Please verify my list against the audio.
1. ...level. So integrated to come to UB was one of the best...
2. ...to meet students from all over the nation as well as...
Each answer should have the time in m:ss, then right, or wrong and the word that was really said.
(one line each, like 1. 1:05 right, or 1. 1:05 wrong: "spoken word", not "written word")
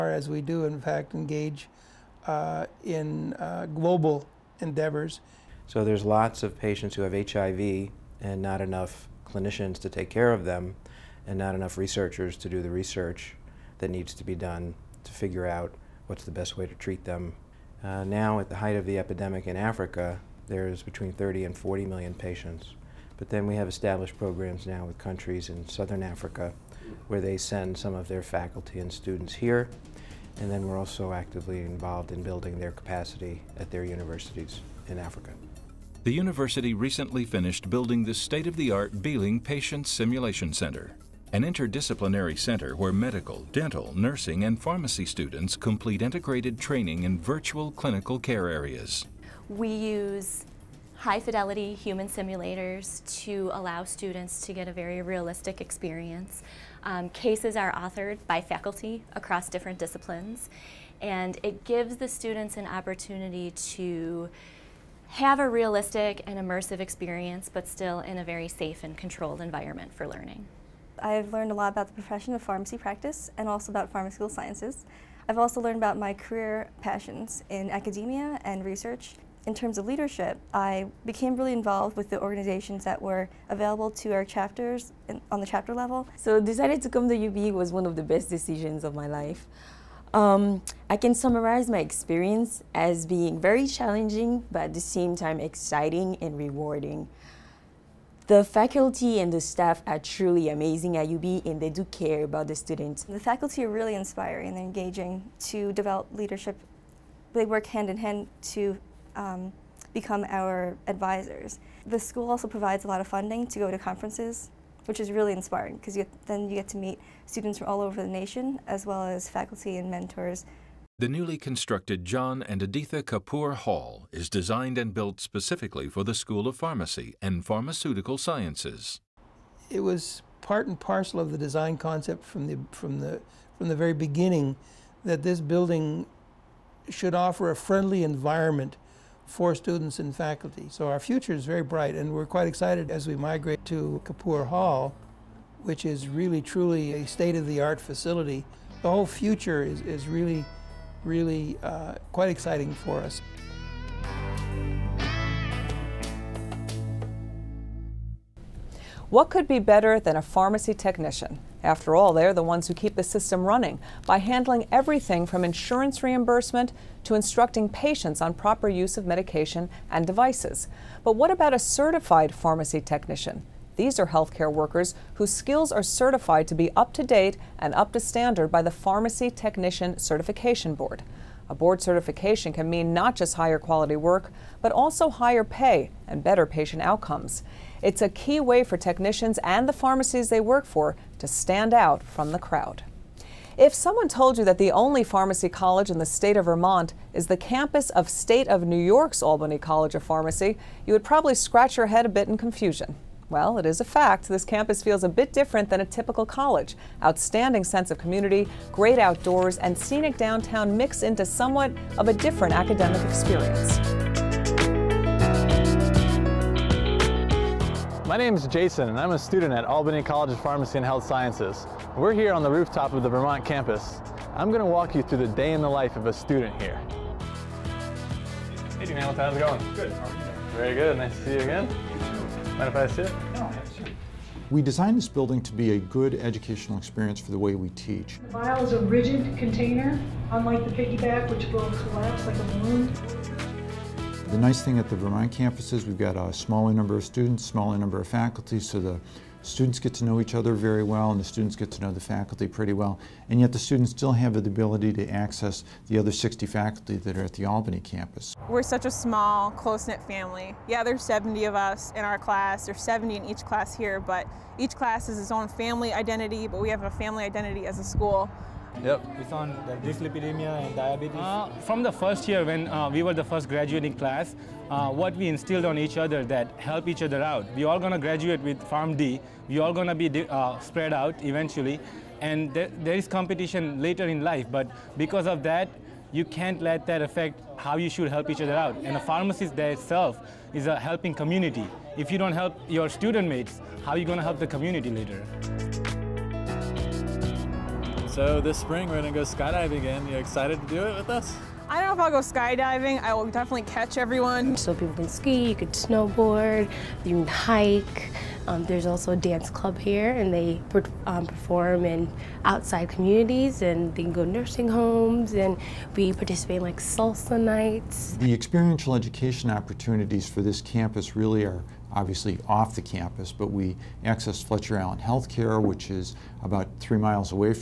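1. 1:25 wrong: "decided", not "integrated"
2. 1:56 right.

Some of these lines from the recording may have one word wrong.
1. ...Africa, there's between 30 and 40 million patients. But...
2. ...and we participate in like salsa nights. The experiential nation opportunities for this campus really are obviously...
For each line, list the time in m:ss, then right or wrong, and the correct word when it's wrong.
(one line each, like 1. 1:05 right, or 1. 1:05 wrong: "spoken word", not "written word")
1. 0:19 right
2. 5:15 wrong: "education", not "nation".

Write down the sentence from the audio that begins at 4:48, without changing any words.
And a pharmacist there itself is a helping community.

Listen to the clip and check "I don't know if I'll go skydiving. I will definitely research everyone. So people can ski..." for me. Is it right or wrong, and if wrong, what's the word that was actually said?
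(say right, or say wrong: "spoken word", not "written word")
wrong: "catch", not "research".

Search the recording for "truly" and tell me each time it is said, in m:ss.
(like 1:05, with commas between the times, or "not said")
1:39, 2:26.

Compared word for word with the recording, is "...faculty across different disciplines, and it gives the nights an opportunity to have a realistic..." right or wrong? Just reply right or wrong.
wrong.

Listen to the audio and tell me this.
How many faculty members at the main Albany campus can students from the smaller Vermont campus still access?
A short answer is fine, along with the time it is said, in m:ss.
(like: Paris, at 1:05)
60, at 4:16.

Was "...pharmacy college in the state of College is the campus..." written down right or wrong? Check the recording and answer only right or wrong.
wrong.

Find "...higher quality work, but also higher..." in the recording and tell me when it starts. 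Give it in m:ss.
3:03.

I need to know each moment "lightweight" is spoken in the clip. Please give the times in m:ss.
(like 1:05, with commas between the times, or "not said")
not said.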